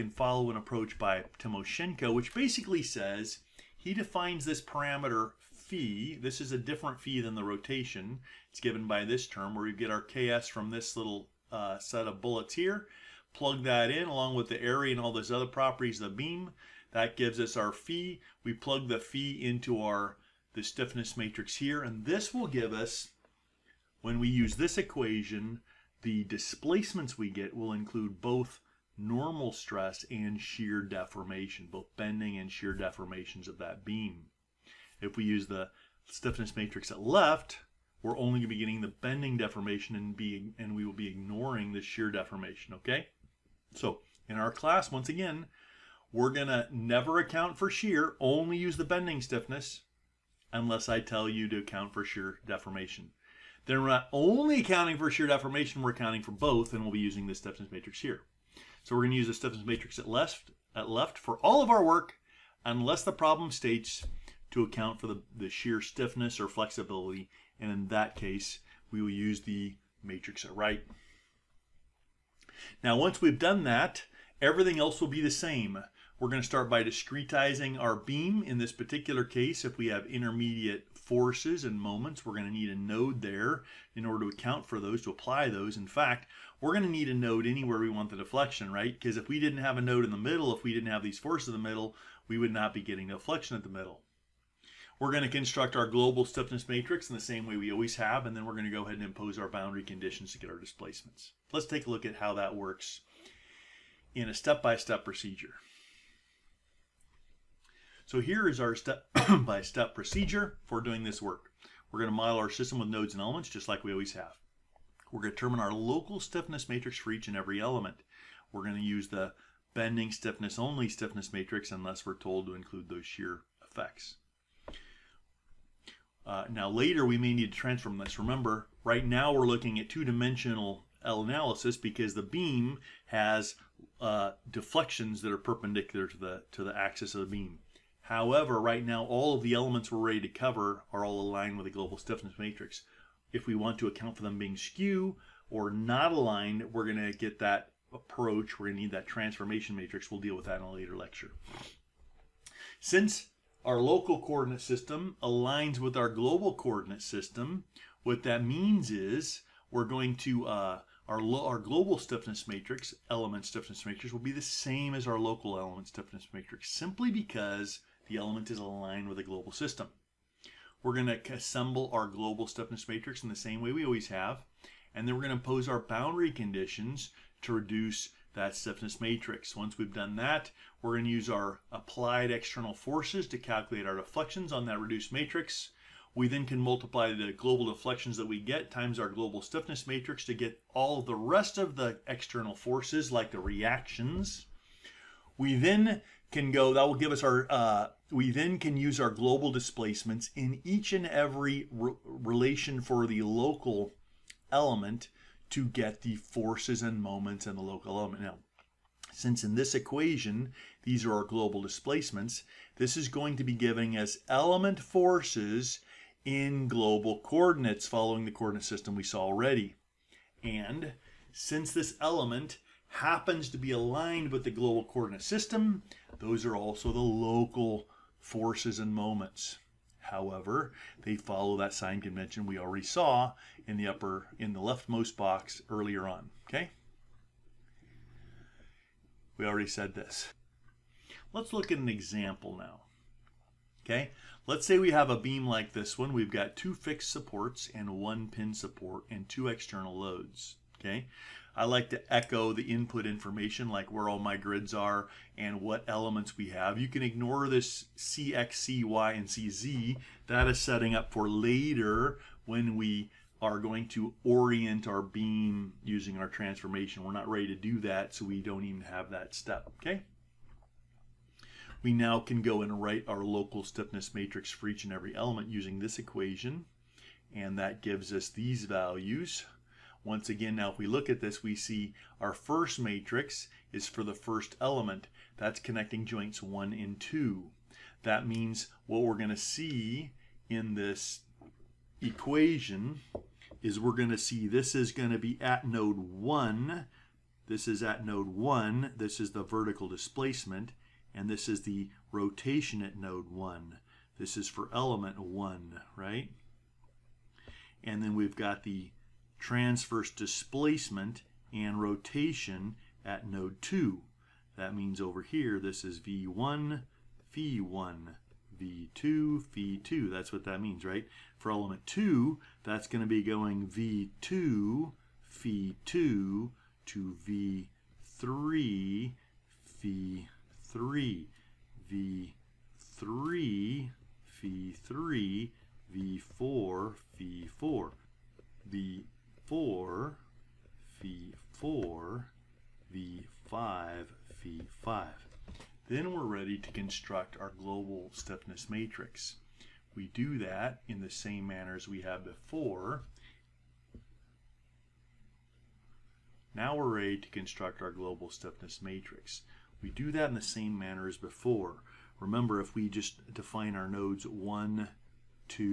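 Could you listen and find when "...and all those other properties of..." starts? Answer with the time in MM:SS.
00:14.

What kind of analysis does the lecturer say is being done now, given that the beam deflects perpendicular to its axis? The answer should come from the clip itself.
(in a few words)
two-dimensional.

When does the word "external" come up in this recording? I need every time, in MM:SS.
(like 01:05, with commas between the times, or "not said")
03:02, 03:12, 04:09.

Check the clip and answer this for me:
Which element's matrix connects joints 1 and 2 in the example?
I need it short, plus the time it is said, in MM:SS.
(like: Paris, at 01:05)
first element, at 04:44.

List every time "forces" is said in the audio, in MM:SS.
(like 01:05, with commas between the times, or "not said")
01:20, 01:31, 03:02, 03:12, 03:26, 03:34, 03:48.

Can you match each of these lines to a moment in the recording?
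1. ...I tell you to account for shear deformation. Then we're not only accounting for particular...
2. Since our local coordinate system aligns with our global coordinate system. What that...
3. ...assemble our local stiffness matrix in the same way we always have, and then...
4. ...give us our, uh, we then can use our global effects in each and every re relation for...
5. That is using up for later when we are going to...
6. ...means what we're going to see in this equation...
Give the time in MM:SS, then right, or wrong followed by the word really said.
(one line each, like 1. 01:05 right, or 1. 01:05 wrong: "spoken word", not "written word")
1. 00:50 wrong: "shear", not "particular"
2. 02:32 right
3. 02:51 wrong: "global", not "local"
4. 03:16 wrong: "displacements", not "effects"
5. 04:20 wrong: "setting", not "using"
6. 04:48 right.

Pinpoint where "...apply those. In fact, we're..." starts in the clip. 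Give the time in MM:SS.
01:25.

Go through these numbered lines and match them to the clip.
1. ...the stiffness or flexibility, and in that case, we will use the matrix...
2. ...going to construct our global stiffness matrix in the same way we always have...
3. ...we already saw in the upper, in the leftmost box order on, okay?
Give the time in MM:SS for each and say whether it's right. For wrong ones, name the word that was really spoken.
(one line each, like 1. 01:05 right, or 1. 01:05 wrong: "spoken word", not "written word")
1. 01:05 right
2. 01:35 right
3. 03:52 wrong: "earlier", not "order".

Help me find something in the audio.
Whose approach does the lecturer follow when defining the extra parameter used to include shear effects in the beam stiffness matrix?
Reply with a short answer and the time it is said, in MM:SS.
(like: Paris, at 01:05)
Timoshenko, at 00:01.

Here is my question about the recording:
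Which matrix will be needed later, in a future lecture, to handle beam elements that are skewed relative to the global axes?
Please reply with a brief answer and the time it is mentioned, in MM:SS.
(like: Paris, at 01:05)
transformation matrix, at 02:29.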